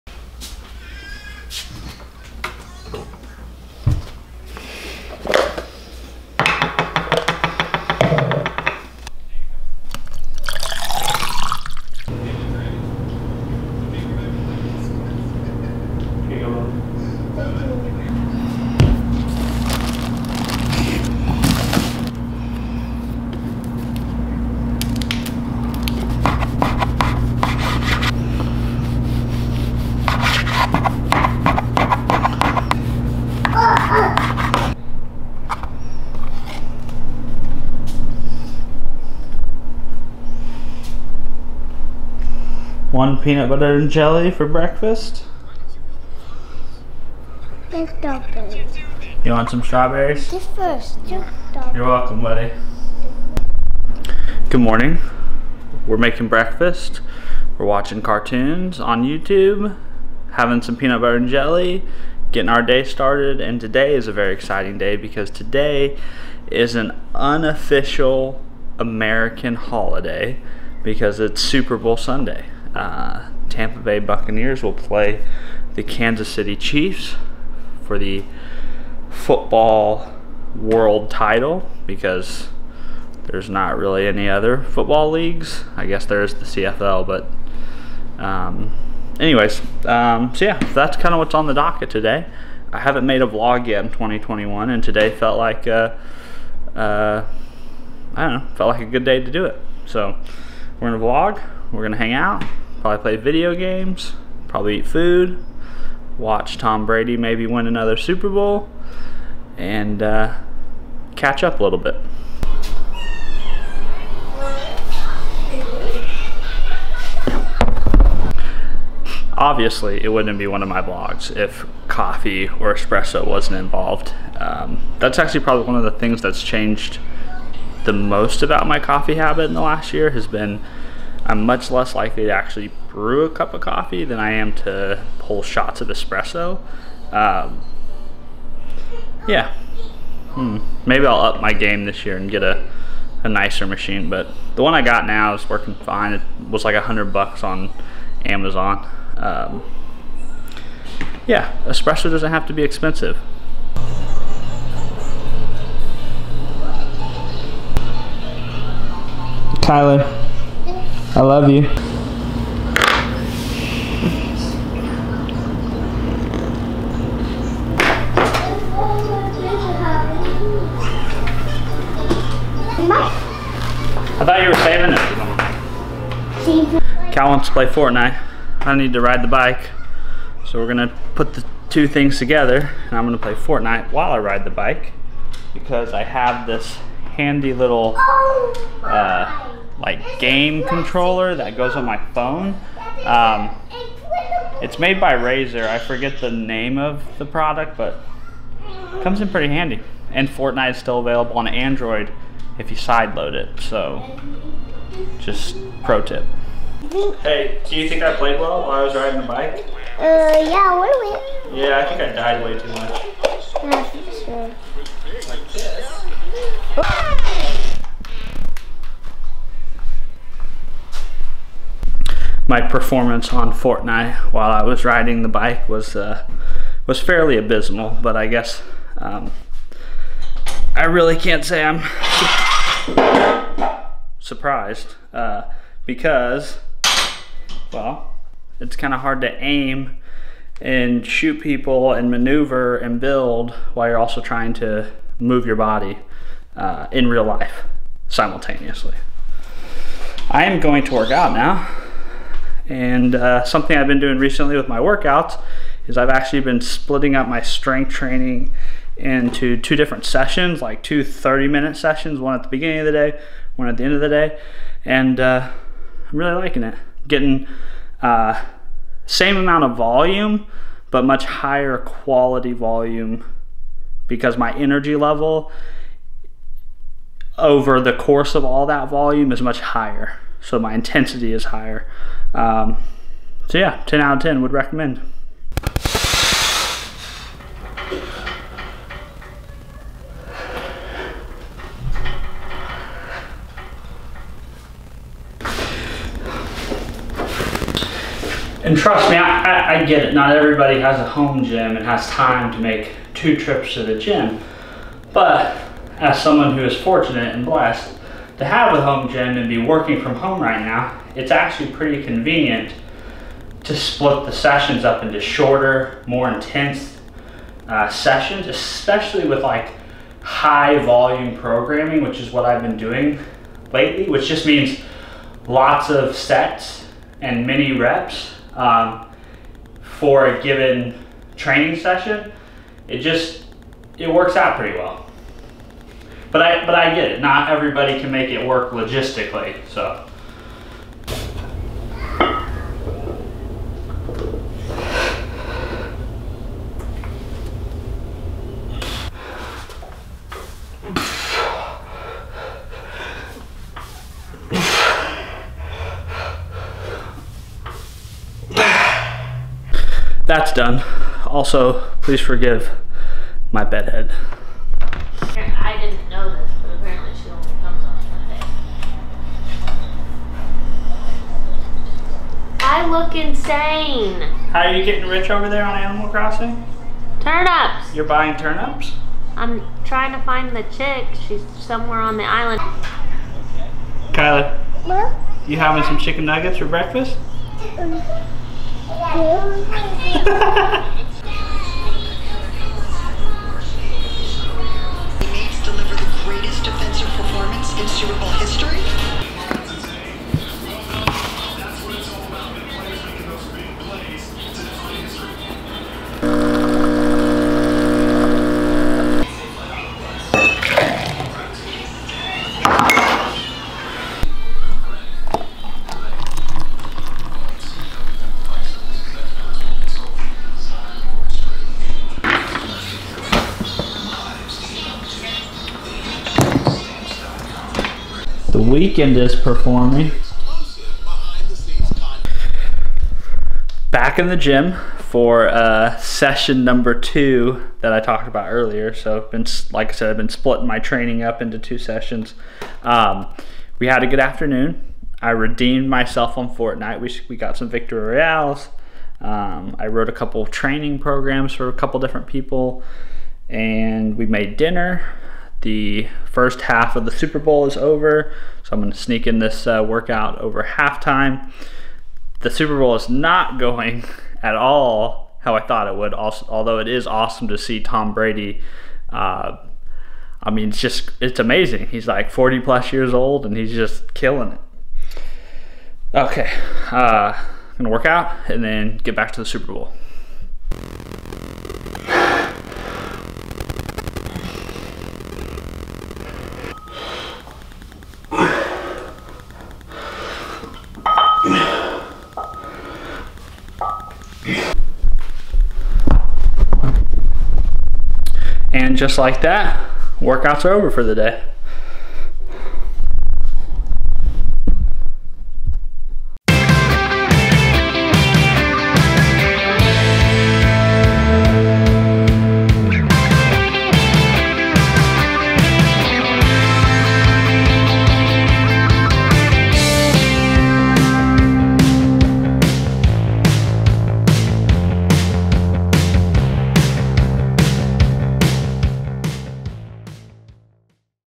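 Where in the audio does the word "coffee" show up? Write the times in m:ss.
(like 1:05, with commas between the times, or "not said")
2:01, 2:08, 2:13.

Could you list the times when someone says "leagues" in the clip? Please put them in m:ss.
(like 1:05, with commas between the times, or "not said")
1:25.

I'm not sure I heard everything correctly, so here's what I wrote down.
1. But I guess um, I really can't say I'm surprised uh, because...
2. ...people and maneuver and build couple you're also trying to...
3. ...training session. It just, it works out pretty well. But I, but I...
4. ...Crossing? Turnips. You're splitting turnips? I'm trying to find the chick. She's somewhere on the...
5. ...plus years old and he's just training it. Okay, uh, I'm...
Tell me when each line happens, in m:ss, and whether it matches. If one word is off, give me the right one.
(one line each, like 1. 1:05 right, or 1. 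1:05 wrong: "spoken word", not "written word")
1. 3:48 right
2. 4:01 wrong: "while", not "couple"
3. 5:31 right
4. 6:16 wrong: "buying", not "splitting"
5. 7:52 wrong: "killing", not "training".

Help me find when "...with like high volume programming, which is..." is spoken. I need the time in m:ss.
5:19.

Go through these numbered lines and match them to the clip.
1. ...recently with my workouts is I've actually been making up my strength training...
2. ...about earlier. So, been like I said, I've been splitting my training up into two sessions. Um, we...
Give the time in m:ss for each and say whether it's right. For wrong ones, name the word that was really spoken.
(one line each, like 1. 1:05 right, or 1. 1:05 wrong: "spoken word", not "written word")
1. 4:14 wrong: "splitting", not "making"
2. 7:18 right.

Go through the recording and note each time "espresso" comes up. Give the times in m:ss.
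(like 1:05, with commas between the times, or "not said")
2:02, 2:15, 2:31.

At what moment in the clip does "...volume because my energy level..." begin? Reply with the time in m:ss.
4:32.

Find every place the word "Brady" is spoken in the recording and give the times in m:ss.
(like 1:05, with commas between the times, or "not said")
1:46, 7:48.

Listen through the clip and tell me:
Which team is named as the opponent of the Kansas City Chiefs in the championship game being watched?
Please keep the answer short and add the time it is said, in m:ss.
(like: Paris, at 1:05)
Tampa Bay Buccaneers, at 1:13.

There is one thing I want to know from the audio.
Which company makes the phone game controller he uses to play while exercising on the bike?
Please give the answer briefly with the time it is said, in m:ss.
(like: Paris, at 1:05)
Razer, at 3:15.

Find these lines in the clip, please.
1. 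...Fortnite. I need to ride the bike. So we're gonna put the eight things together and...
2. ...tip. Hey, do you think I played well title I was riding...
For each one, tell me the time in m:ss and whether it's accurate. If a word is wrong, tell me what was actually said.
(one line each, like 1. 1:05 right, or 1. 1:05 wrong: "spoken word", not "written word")
1. 2:57 wrong: "two", not "eight"
2. 3:26 wrong: "while", not "title".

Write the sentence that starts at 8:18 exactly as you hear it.
And just like that, workouts are over for the day.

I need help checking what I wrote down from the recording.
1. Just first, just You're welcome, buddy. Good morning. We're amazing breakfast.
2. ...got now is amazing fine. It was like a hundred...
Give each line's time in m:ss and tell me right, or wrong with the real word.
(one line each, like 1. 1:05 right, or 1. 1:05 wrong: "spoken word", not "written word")
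1. 0:50 wrong: "making", not "amazing"
2. 2:24 wrong: "working", not "amazing".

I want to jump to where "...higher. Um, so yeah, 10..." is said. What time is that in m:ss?
4:41.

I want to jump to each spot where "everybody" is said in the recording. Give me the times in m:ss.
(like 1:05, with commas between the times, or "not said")
5:00, 5:37.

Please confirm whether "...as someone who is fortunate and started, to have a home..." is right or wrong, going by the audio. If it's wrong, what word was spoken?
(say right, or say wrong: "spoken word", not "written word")
wrong: "blessed", not "started".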